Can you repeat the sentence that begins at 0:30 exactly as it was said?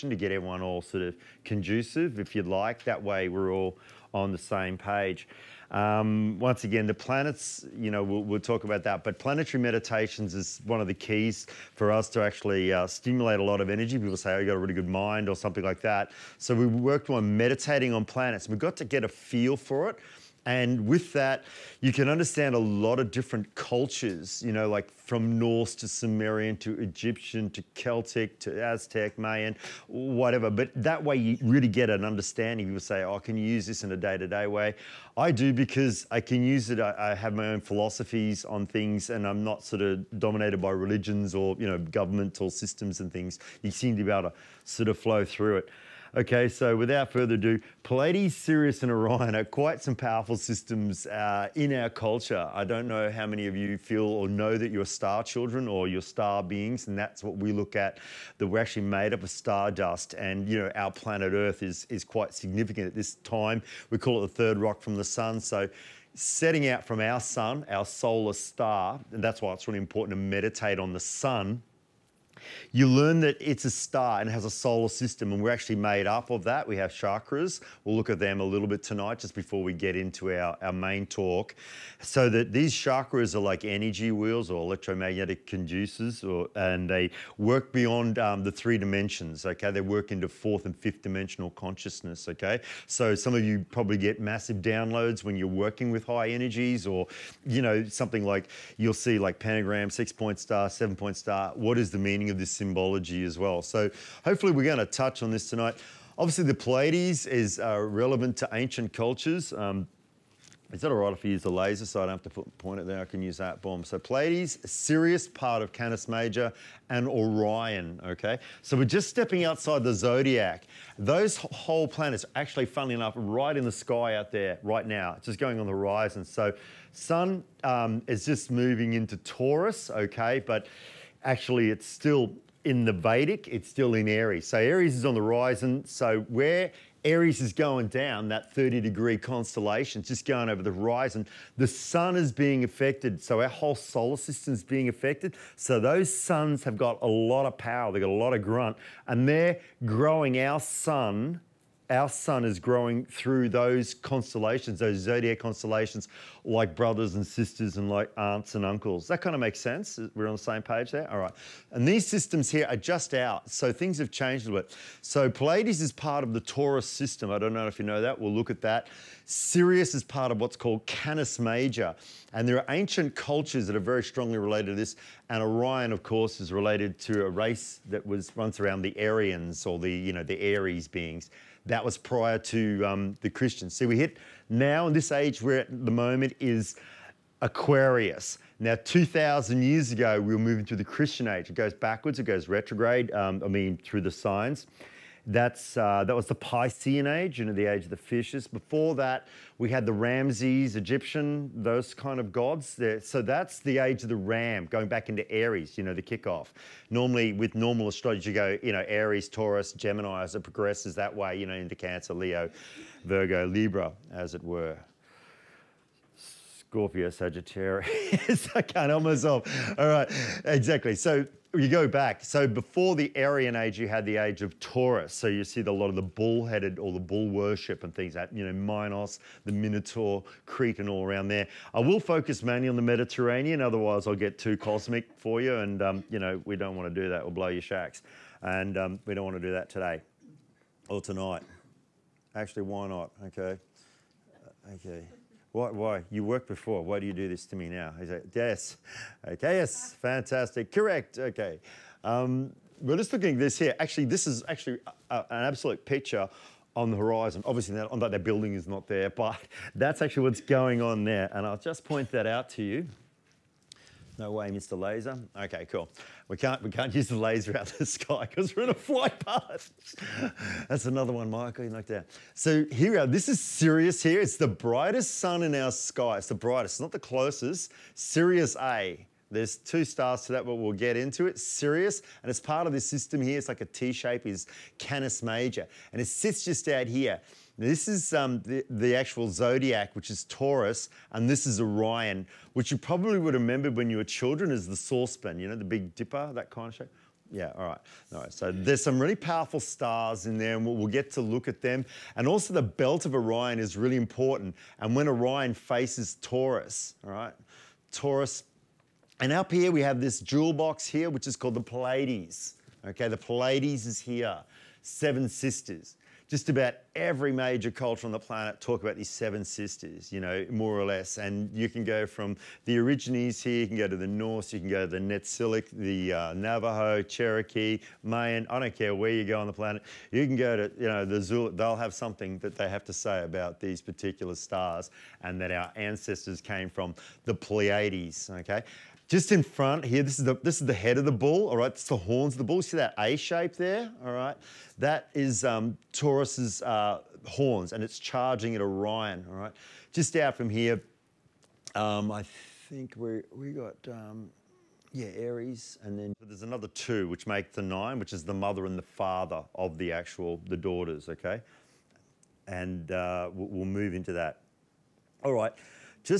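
But that way you really get an understanding.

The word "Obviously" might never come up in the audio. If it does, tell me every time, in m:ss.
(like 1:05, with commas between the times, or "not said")
1:46, 4:17.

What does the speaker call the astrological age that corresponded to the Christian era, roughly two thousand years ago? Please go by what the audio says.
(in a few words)
Piscean age.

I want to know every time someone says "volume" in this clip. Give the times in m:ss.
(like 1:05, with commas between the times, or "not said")
not said.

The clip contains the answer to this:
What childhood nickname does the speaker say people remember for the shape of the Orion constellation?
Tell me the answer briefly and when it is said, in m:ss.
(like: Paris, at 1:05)
the saucepan, at 4:54.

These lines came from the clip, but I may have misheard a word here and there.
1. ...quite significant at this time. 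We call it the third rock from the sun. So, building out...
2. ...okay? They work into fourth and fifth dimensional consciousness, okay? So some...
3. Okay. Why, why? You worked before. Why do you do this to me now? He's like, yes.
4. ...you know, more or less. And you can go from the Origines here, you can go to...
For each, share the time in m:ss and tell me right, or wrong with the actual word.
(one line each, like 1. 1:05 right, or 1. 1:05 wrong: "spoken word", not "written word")
1. 1:02 wrong: "setting", not "building"
2. 1:29 right
3. 4:04 right
4. 5:20 right.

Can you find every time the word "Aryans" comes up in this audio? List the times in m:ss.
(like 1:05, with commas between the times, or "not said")
2:58, 3:43.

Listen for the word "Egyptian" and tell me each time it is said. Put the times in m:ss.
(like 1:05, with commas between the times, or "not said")
0:26, 3:20.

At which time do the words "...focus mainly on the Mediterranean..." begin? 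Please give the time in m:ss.
3:51.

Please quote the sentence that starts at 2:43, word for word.
So things have changed a bit.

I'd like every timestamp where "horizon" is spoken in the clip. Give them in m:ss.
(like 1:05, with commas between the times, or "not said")
2:05, 2:15, 2:20, 4:16.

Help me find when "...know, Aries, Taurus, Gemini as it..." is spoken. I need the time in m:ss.
3:28.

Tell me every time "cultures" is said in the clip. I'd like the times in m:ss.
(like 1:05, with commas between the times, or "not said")
0:23, 0:51, 1:48, 2:53, 5:17.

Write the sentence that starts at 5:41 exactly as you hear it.
It's the horns of the bull.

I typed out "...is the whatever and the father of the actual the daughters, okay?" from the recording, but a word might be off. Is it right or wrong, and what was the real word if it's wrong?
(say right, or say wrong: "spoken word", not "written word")
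wrong: "mother", not "whatever".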